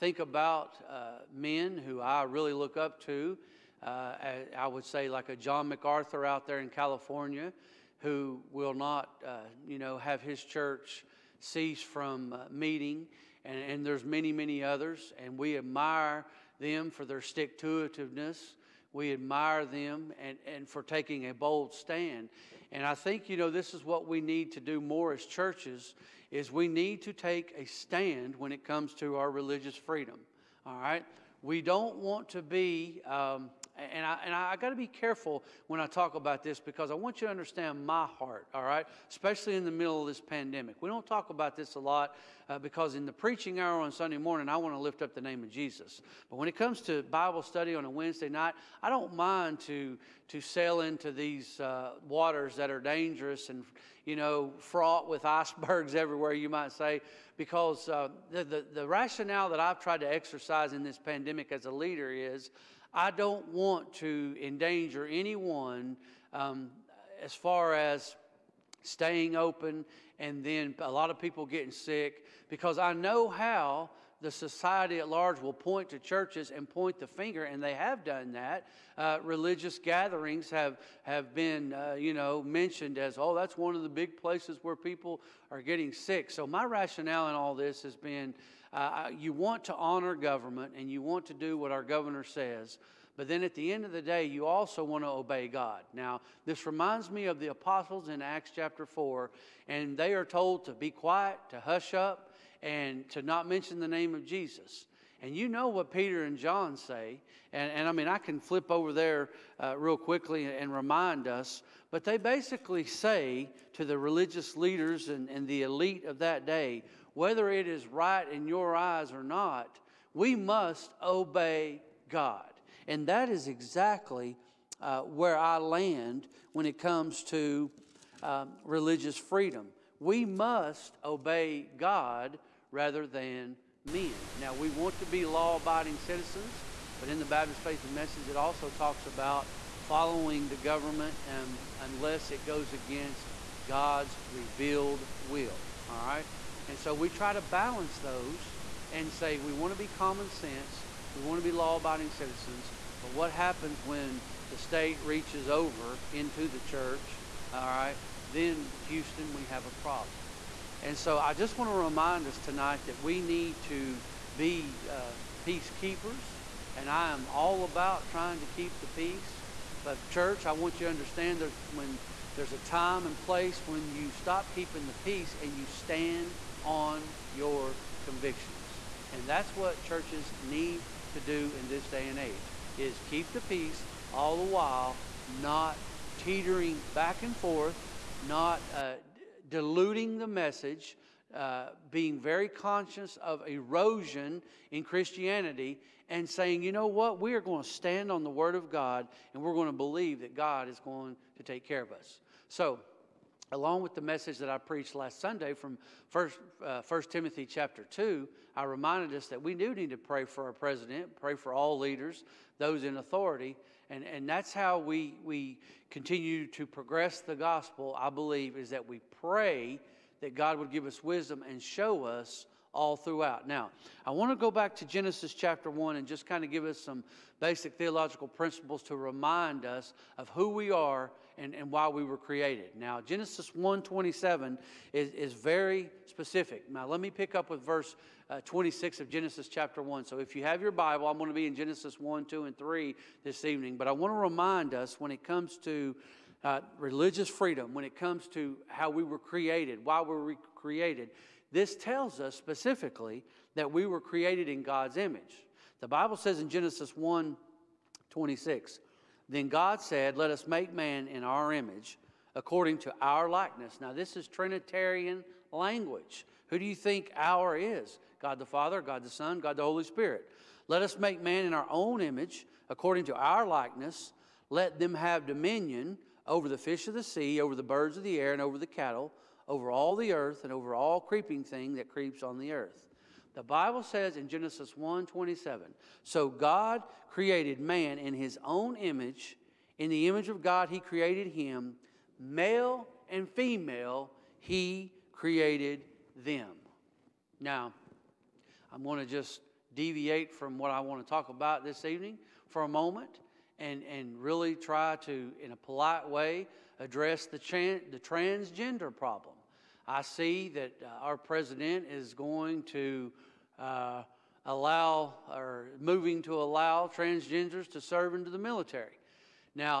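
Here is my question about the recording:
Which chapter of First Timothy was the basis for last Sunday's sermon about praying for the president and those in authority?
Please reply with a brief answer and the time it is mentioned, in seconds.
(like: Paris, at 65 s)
Chapter 2, at 207 s.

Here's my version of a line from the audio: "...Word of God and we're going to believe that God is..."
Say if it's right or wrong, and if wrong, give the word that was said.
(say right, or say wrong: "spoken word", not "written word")
right.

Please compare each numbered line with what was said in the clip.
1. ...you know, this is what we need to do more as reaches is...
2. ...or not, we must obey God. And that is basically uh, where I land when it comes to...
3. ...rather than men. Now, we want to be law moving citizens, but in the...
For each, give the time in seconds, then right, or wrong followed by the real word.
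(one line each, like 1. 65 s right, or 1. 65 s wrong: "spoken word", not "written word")
1. 23 s wrong: "churches", not "reaches"
2. 119 s wrong: "exactly", not "basically"
3. 132 s wrong: "abiding", not "moving".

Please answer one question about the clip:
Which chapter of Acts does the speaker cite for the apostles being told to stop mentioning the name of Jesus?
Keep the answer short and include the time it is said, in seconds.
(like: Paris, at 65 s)
Acts chapter 4, at 98 s.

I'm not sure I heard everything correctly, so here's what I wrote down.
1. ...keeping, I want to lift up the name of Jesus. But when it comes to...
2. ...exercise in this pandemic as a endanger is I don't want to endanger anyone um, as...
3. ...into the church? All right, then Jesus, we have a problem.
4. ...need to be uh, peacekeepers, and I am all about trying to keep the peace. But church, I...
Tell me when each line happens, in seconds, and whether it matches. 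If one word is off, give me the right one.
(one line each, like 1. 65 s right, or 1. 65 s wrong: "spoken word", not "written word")
1. 44 s wrong: "morning", not "keeping"
2. 60 s wrong: "leader", not "endanger"
3. 156 s wrong: "Houston", not "Jesus"
4. 163 s right.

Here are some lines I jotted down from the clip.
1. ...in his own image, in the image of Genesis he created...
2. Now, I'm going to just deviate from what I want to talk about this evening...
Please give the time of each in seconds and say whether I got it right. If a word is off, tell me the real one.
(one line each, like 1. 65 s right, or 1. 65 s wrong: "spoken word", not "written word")
1. 287 s wrong: "God", not "Genesis"
2. 297 s right.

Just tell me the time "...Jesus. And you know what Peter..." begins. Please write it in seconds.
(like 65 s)
104 s.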